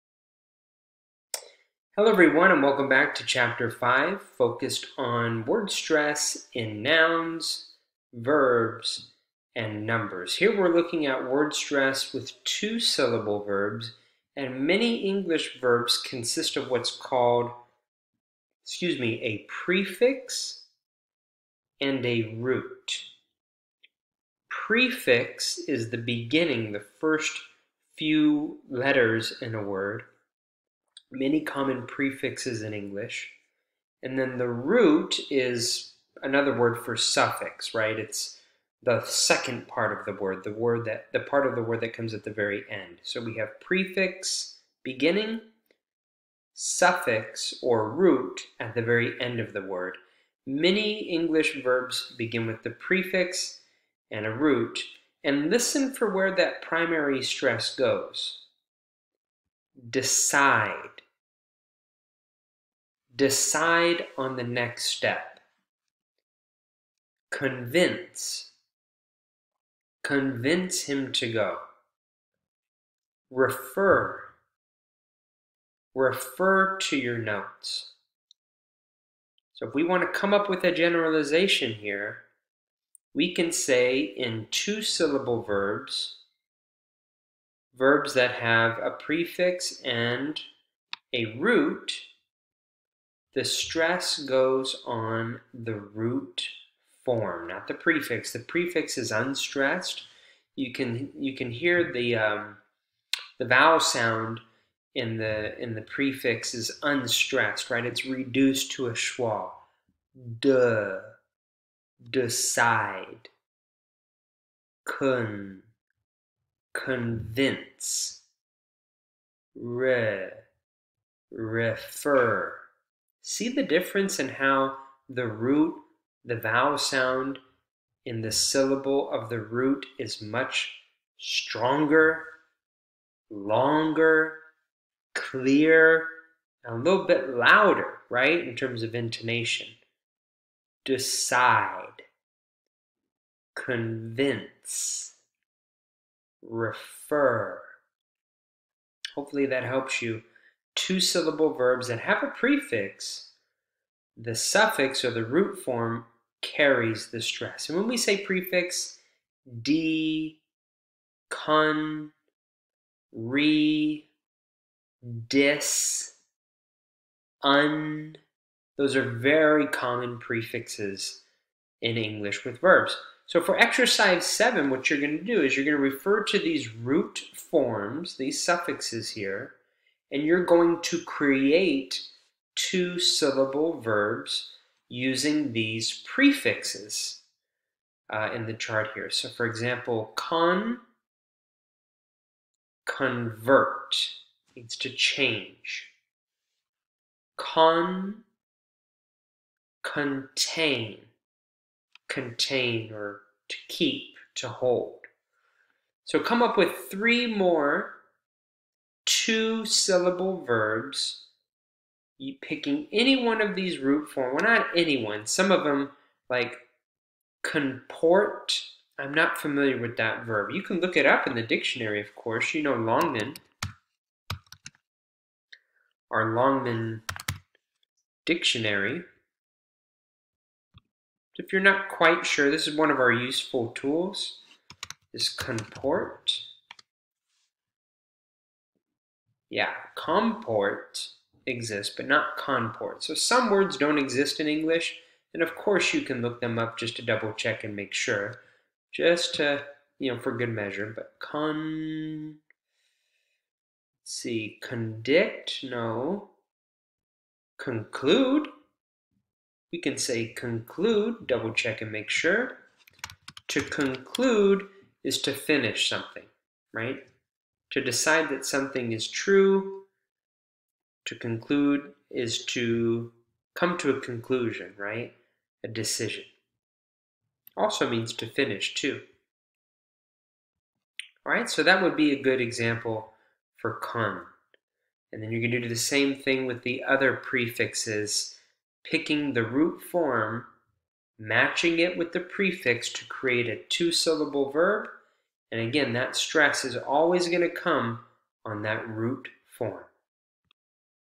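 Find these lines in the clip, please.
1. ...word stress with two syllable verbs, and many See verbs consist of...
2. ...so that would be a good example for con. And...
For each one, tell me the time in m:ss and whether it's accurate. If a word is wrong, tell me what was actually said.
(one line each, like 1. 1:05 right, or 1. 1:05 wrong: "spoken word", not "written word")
1. 0:11 wrong: "English", not "See"
2. 4:41 right.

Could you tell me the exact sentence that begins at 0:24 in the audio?
Prefix is the beginning, the first few letters in a word many common prefixes in English.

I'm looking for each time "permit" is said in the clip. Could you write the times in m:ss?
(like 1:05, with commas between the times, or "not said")
not said.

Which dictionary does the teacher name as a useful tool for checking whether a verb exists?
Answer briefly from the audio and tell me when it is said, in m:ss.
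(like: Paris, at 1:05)
Longman, at 3:46.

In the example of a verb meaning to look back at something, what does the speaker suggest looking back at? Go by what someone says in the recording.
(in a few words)
your notes.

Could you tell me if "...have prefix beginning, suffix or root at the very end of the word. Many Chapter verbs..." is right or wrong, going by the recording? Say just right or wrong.
wrong.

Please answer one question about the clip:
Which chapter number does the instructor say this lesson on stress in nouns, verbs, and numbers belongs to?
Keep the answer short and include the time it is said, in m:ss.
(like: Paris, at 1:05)
5, at 0:03.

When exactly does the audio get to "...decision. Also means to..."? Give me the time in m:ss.
4:35.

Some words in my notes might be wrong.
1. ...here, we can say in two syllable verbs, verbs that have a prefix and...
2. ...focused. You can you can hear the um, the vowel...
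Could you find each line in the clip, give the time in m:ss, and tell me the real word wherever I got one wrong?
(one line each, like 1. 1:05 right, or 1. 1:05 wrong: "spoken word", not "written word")
1. 1:21 right
2. 1:39 wrong: "unstressed", not "focused".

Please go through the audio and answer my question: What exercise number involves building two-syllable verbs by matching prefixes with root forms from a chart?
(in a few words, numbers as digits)
7.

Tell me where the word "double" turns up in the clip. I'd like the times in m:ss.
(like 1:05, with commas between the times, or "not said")
4:07, 4:21.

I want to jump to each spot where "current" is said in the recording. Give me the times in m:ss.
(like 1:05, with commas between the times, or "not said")
not said.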